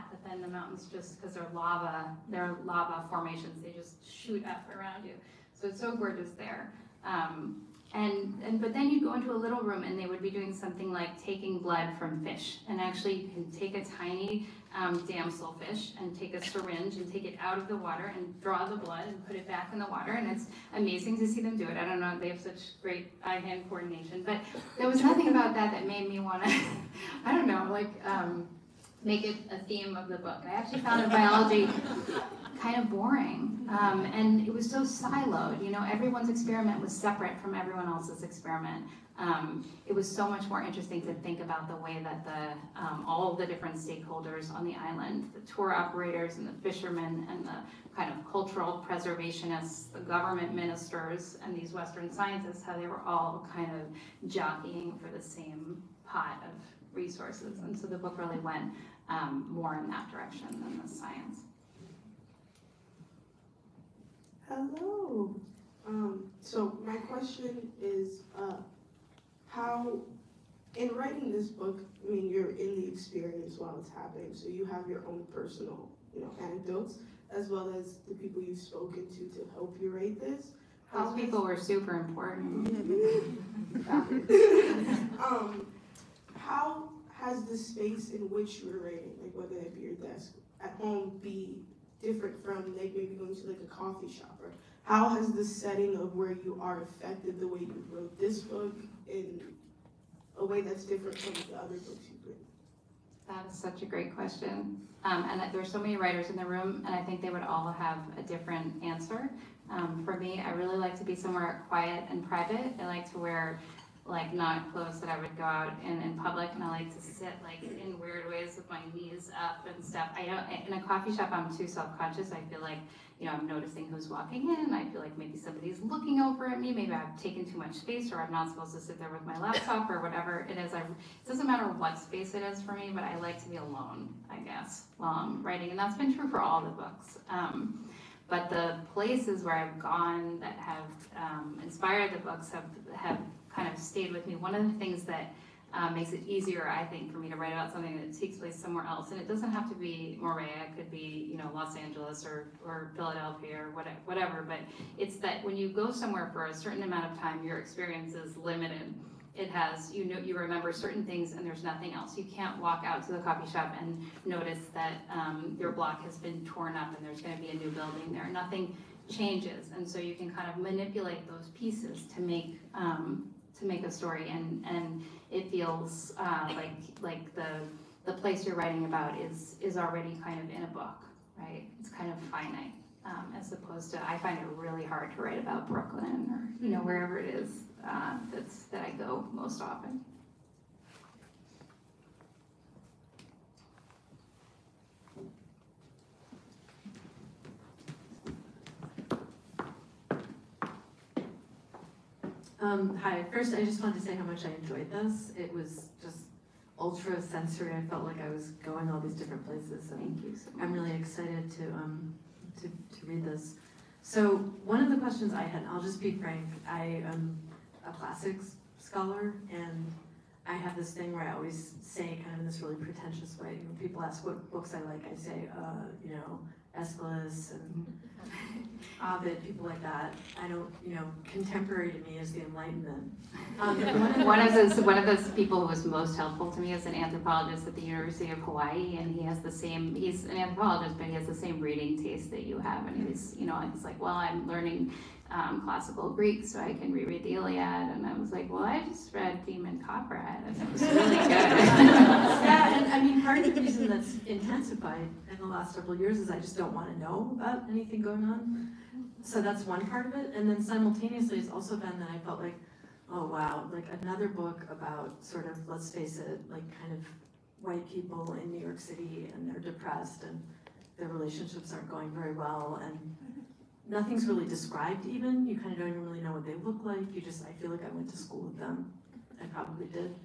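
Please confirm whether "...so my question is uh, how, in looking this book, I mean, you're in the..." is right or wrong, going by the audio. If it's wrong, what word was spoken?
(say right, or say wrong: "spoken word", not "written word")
wrong: "writing", not "looking".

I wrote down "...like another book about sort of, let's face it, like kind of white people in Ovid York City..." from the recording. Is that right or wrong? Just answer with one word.
wrong.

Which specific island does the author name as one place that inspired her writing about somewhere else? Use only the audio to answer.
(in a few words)
Moorea.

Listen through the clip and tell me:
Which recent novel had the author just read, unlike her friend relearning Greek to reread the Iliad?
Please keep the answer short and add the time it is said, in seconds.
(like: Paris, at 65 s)
Demon Copperhead, at 249 s.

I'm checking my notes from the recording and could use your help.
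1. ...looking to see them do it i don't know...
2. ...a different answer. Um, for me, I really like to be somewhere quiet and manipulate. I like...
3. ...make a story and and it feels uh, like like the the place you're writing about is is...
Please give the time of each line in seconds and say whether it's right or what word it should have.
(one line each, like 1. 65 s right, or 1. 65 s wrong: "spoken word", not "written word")
1. 20 s wrong: "amazing", not "looking"
2. 108 s wrong: "private", not "manipulate"
3. 173 s right.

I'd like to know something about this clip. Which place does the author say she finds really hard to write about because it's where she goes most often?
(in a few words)
Brooklyn.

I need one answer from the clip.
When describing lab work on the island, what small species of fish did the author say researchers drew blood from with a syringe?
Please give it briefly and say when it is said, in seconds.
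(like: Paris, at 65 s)
damselfish, at 15 s.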